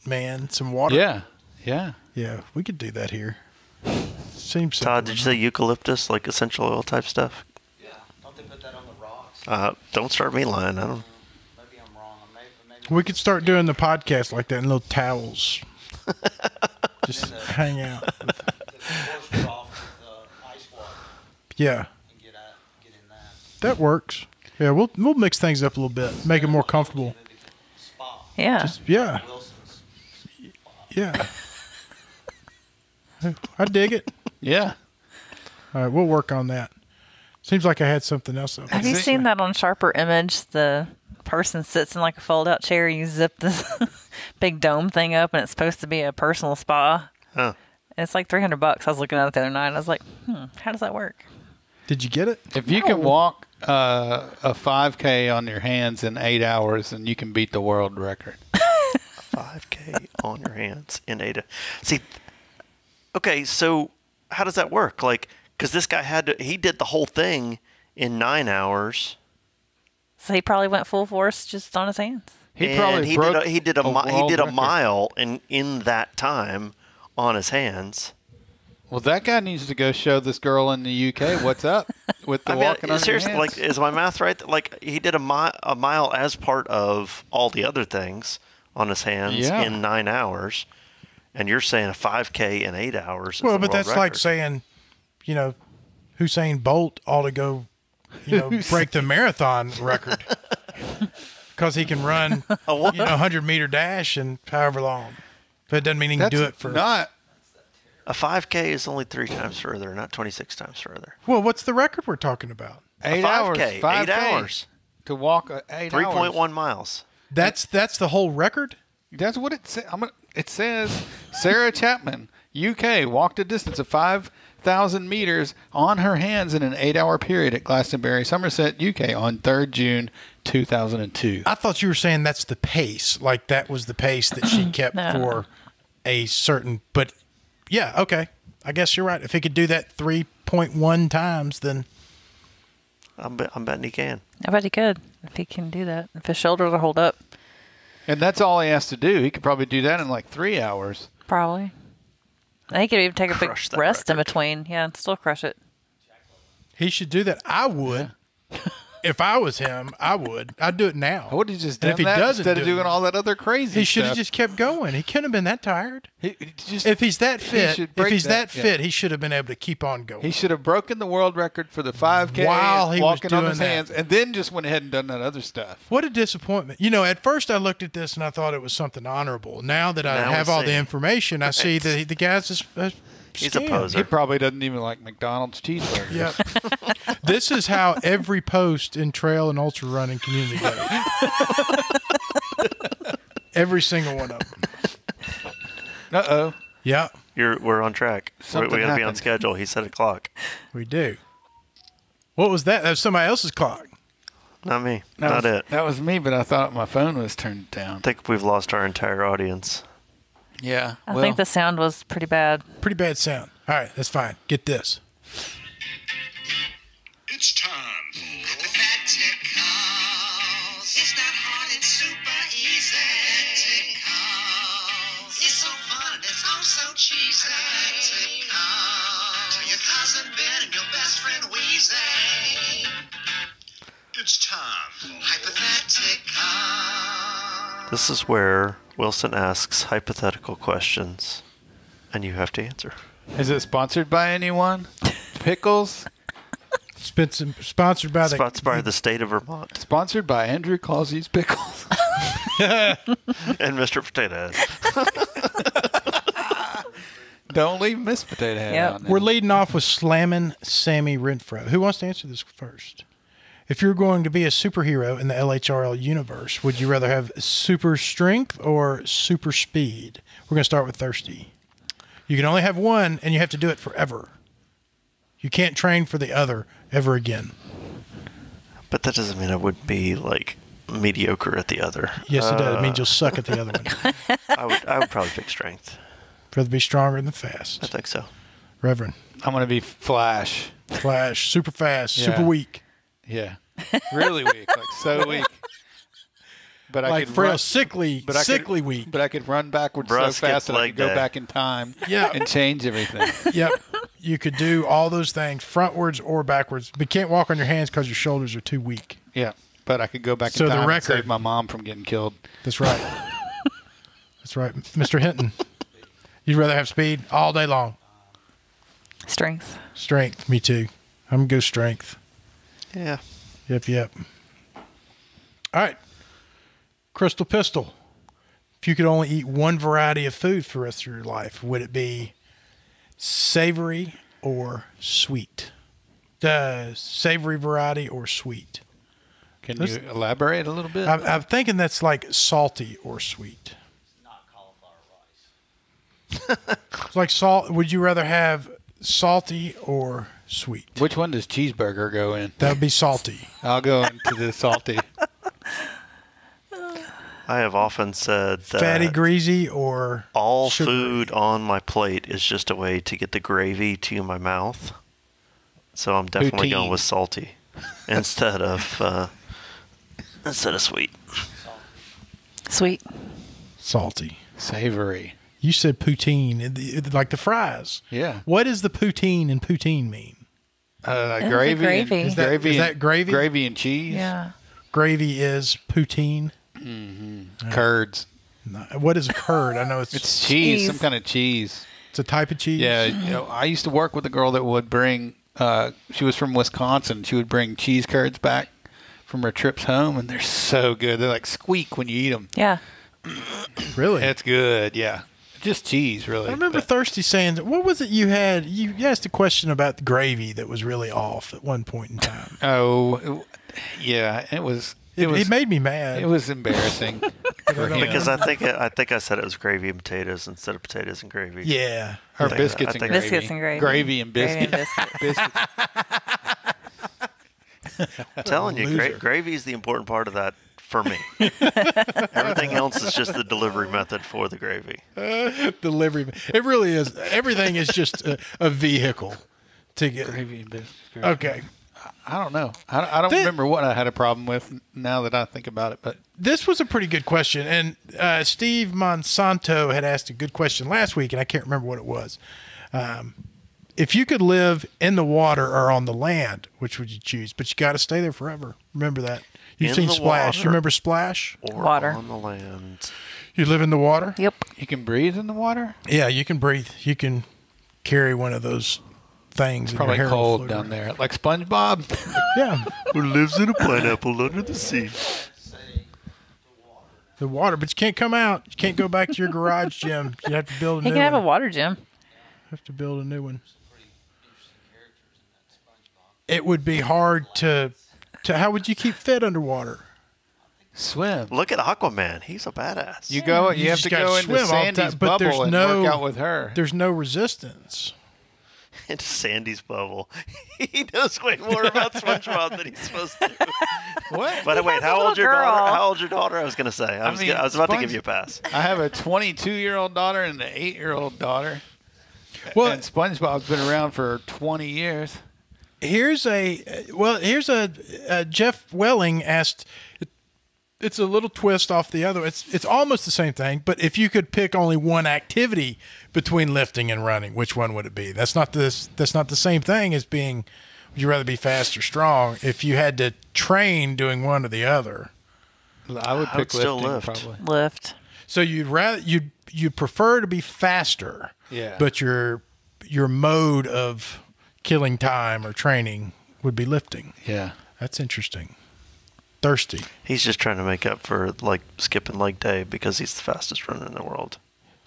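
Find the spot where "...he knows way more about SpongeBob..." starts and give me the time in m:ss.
8:20.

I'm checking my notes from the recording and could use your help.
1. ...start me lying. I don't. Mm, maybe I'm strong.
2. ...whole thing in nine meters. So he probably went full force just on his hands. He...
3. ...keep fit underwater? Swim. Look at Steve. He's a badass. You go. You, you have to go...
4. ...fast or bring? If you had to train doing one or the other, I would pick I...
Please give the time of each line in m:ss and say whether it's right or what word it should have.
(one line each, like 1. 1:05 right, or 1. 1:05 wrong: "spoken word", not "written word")
1. 0:10 wrong: "wrong", not "strong"
2. 1:06 wrong: "hours", not "meters"
3. 8:08 wrong: "Aquaman", not "Steve"
4. 8:51 wrong: "strong", not "bring".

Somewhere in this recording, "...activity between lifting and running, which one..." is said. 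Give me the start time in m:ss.
8:45.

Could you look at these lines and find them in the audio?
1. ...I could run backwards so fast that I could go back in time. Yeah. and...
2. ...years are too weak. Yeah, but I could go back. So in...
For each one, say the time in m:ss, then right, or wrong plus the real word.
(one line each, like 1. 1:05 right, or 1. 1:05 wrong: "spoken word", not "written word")
1. 4:59 right
2. 5:08 wrong: "shoulders", not "years".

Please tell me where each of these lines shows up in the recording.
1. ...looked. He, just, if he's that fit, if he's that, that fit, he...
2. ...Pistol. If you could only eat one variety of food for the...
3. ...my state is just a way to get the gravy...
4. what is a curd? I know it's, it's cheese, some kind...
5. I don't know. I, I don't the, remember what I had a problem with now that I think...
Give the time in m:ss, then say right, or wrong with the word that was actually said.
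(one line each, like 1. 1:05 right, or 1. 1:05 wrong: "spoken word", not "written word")
1. 2:45 wrong: "tired", not "looked"
2. 5:27 right
3. 6:01 wrong: "plate", not "state"
4. 6:28 right
5. 7:22 right.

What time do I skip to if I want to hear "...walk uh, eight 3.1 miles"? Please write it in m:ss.
1:55.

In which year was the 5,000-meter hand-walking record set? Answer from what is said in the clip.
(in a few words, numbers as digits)
2002.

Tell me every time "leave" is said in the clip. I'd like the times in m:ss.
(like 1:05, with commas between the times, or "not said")
4:17.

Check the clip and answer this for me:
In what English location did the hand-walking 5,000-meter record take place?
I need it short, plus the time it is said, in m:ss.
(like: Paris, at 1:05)
Glastonbury, at 2:07.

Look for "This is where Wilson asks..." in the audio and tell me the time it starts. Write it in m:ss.
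3:57.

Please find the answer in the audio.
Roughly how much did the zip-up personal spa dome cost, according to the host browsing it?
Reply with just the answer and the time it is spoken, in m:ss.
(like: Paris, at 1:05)
300 bucks, at 0:48.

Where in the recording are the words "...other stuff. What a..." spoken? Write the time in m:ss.
2:55.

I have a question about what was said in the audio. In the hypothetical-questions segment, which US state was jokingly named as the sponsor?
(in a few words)
Vermont.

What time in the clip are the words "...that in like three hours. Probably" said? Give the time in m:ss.
2:29.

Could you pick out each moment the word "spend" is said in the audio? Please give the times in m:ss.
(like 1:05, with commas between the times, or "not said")
not said.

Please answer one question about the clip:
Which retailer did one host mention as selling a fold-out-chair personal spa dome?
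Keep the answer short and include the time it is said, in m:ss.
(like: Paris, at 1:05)
Sharper Image, at 0:39.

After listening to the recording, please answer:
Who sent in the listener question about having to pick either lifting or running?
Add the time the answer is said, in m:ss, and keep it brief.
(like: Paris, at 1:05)
Jeff Wehling, at 8:38.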